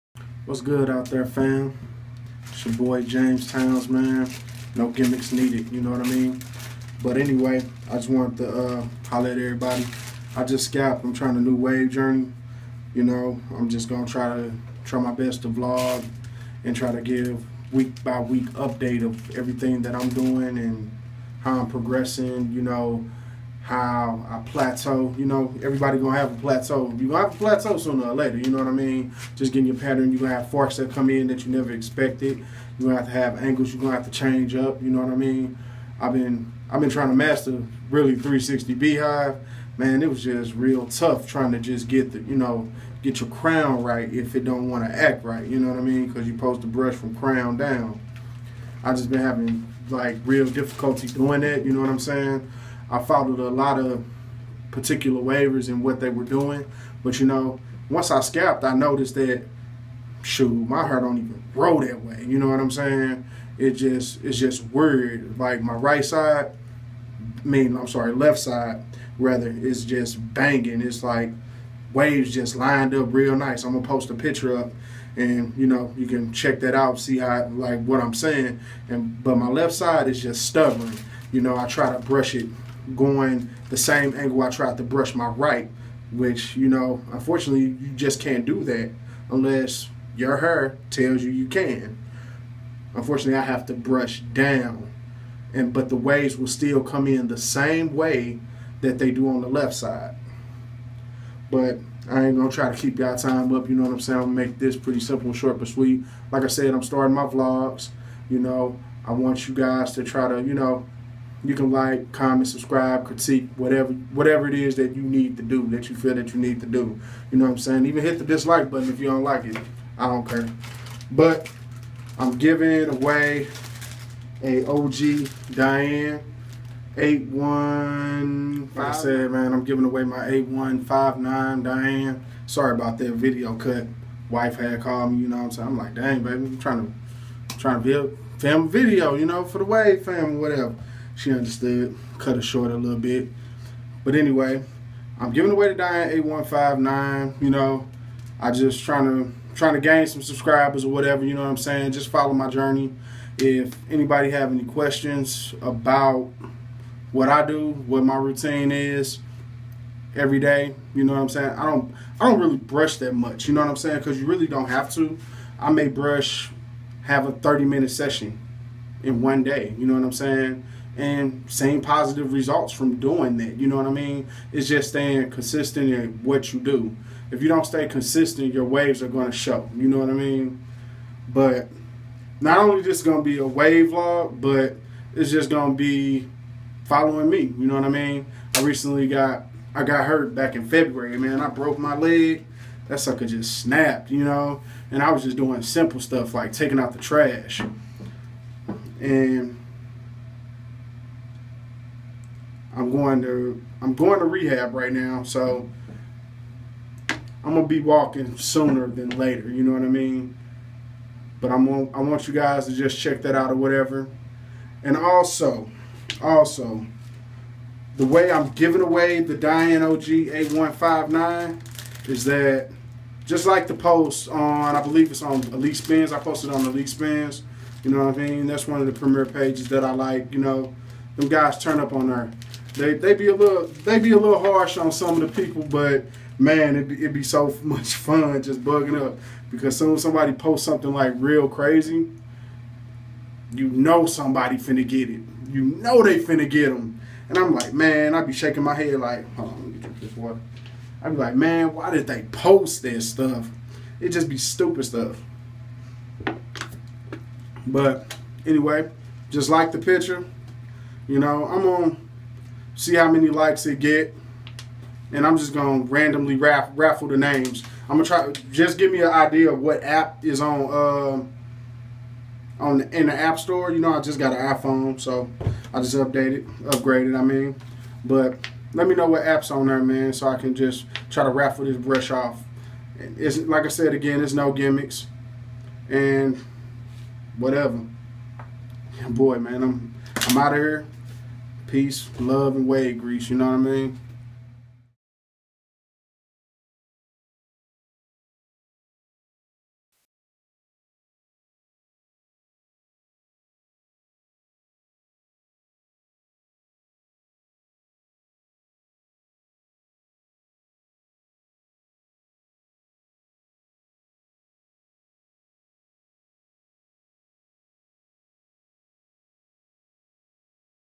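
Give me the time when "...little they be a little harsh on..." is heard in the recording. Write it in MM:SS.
03:53.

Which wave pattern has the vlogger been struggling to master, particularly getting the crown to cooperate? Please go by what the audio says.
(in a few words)
360 beehive.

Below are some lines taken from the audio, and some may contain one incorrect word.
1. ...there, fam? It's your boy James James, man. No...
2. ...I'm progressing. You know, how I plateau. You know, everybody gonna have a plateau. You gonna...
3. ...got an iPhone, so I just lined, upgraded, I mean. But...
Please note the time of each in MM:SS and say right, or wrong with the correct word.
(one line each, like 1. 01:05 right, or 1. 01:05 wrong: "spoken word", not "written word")
1. 00:01 wrong: "Towns", not "James"
2. 00:21 right
3. 04:34 wrong: "updated", not "lined".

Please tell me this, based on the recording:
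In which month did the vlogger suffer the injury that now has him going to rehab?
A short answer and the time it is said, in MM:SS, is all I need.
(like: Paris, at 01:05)
February, at 03:10.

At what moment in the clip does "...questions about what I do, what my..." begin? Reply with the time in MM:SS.
02:34.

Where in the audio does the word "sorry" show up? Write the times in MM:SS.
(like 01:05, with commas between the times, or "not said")
01:07, 02:12.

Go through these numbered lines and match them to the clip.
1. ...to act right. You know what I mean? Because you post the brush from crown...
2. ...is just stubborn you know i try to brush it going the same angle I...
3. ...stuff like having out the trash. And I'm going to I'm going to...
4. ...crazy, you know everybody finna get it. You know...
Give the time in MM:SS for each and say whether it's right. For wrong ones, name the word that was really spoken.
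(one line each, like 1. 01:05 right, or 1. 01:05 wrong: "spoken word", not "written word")
1. 00:44 right
2. 01:20 right
3. 03:16 wrong: "taking", not "having"
4. 04:01 wrong: "somebody", not "everybody".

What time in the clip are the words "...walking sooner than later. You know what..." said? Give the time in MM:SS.
03:27.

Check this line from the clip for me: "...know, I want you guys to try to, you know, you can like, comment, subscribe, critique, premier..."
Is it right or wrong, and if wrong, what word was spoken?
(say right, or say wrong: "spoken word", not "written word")
wrong: "whatever", not "premier".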